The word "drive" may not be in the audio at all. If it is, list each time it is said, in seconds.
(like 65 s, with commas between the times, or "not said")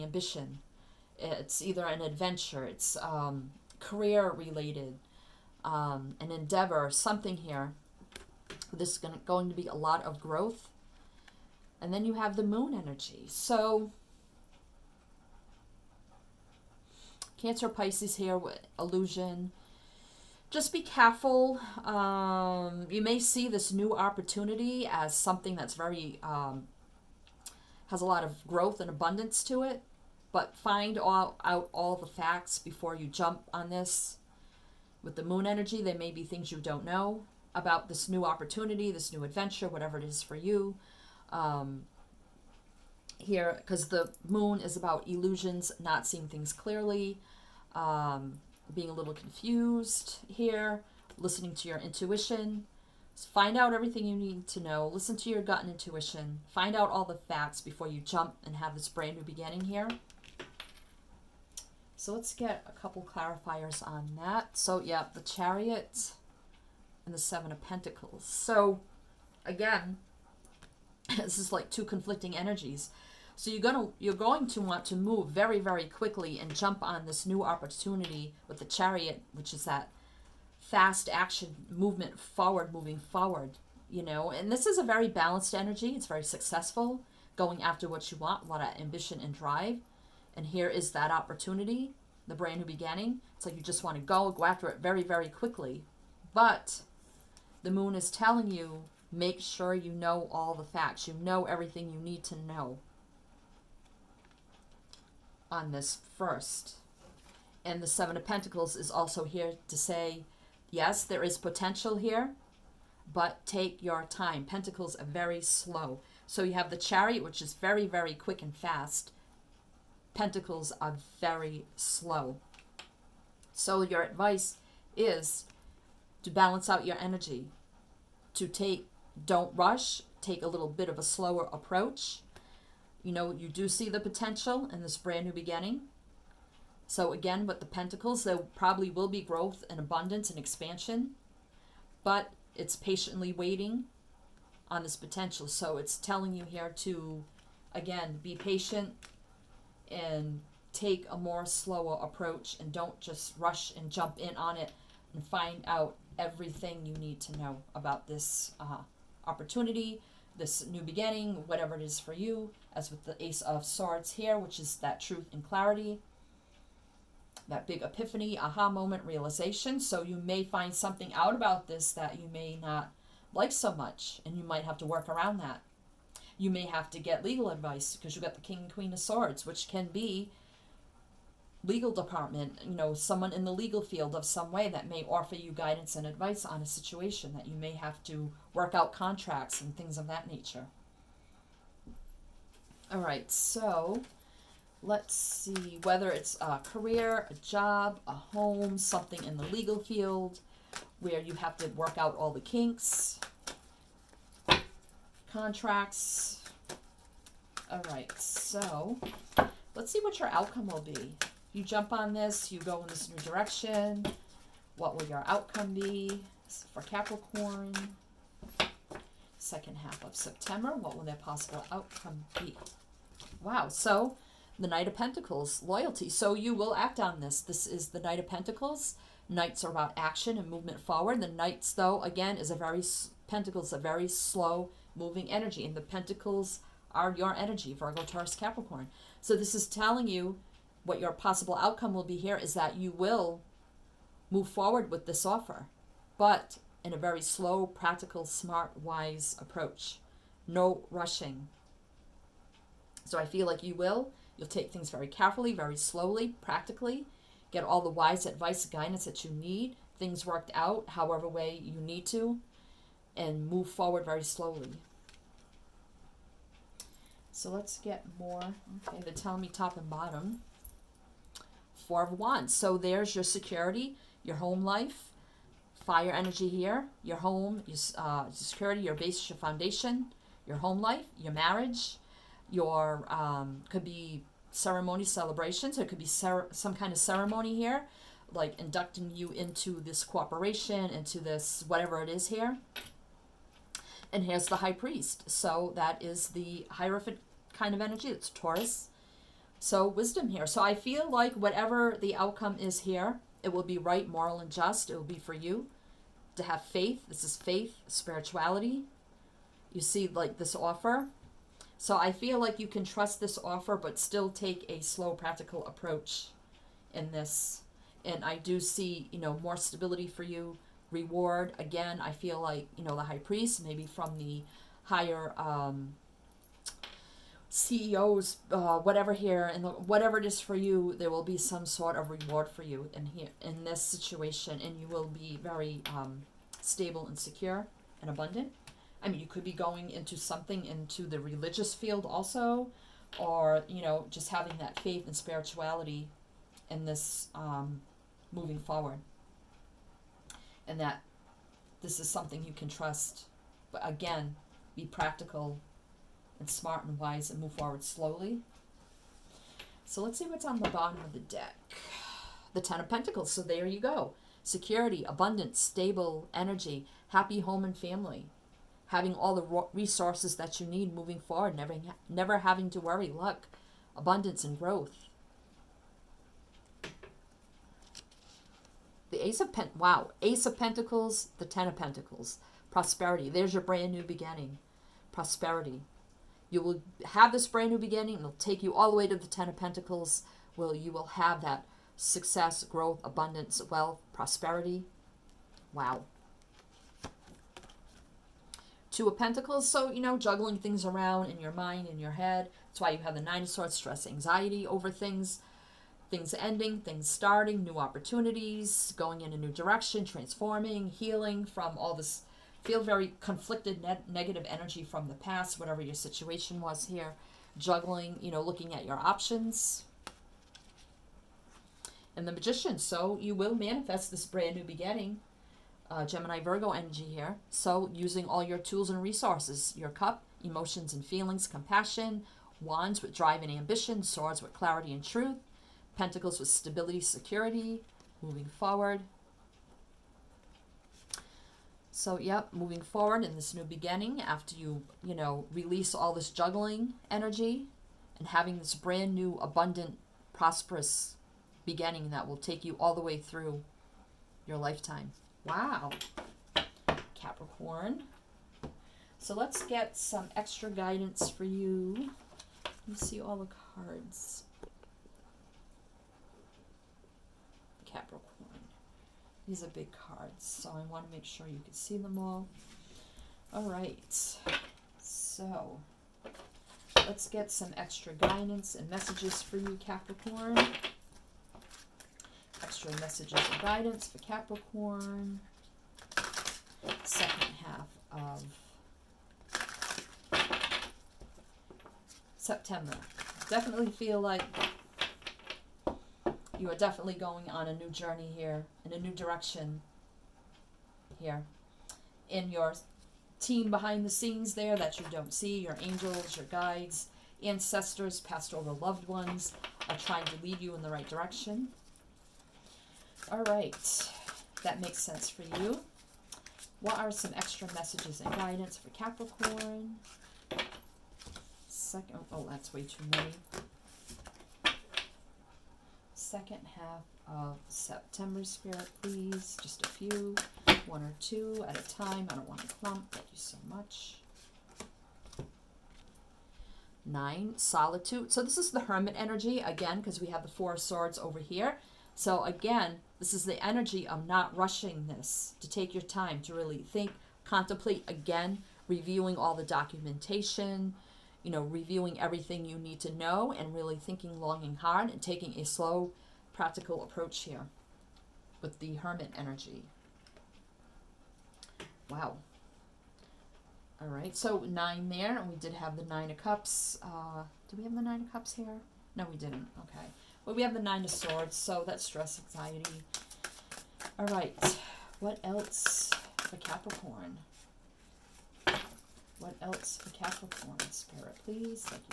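89 s, 433 s.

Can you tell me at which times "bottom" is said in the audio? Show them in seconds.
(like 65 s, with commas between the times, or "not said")
269 s, 360 s.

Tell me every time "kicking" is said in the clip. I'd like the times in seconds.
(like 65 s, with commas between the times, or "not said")
not said.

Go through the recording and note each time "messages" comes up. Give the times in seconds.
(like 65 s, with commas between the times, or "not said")
478 s, 482 s, 517 s.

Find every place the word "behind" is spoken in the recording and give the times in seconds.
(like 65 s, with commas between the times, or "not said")
503 s.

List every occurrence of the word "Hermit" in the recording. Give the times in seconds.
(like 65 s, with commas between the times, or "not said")
538 s, 558 s.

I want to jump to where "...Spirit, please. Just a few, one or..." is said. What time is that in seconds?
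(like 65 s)
528 s.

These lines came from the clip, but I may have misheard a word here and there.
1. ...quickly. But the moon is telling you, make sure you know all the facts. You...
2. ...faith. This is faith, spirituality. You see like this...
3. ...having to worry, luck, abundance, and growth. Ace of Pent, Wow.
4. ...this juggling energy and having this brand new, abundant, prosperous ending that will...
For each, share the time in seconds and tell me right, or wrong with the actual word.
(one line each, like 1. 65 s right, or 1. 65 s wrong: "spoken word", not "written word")
1. 95 s right
2. 306 s right
3. 372 s right
4. 446 s wrong: "beginning", not "ending".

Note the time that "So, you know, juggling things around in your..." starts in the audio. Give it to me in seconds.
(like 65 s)
399 s.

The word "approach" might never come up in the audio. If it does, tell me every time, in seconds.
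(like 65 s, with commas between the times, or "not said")
131 s, 152 s, 249 s, 315 s, 557 s.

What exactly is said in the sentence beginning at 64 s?
So yeah, the chariot and the seven of pentacles.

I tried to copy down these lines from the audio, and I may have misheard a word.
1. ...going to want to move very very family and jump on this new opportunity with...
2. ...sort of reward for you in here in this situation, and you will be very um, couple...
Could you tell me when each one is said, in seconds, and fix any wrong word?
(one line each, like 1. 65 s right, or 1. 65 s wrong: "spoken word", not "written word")
1. 74 s wrong: "quickly", not "family"
2. 331 s wrong: "stable", not "couple".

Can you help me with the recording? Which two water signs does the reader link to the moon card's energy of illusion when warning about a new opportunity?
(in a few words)
Cancer Pisces.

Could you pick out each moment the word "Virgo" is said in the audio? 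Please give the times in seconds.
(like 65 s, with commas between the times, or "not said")
237 s, 426 s.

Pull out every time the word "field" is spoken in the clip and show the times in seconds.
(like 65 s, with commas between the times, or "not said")
183 s, 199 s, 341 s.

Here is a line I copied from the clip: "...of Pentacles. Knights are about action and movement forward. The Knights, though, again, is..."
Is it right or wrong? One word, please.
right.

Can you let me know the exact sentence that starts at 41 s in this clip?
Um, here, because the moon is about illusions, not seeing things clearly, um, being a little confused here, listening to your intuition.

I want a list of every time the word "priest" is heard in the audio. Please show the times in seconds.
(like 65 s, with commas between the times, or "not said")
294 s, 323 s.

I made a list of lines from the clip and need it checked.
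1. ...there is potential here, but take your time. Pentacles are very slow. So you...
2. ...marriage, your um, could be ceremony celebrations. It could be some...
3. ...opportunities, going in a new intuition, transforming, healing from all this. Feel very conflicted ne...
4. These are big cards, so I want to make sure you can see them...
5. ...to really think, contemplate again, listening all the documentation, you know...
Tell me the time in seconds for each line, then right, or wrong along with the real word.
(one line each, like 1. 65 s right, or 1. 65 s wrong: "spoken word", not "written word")
1. 111 s right
2. 281 s right
3. 407 s wrong: "direction", not "intuition"
4. 469 s right
5. 546 s wrong: "reviewing", not "listening".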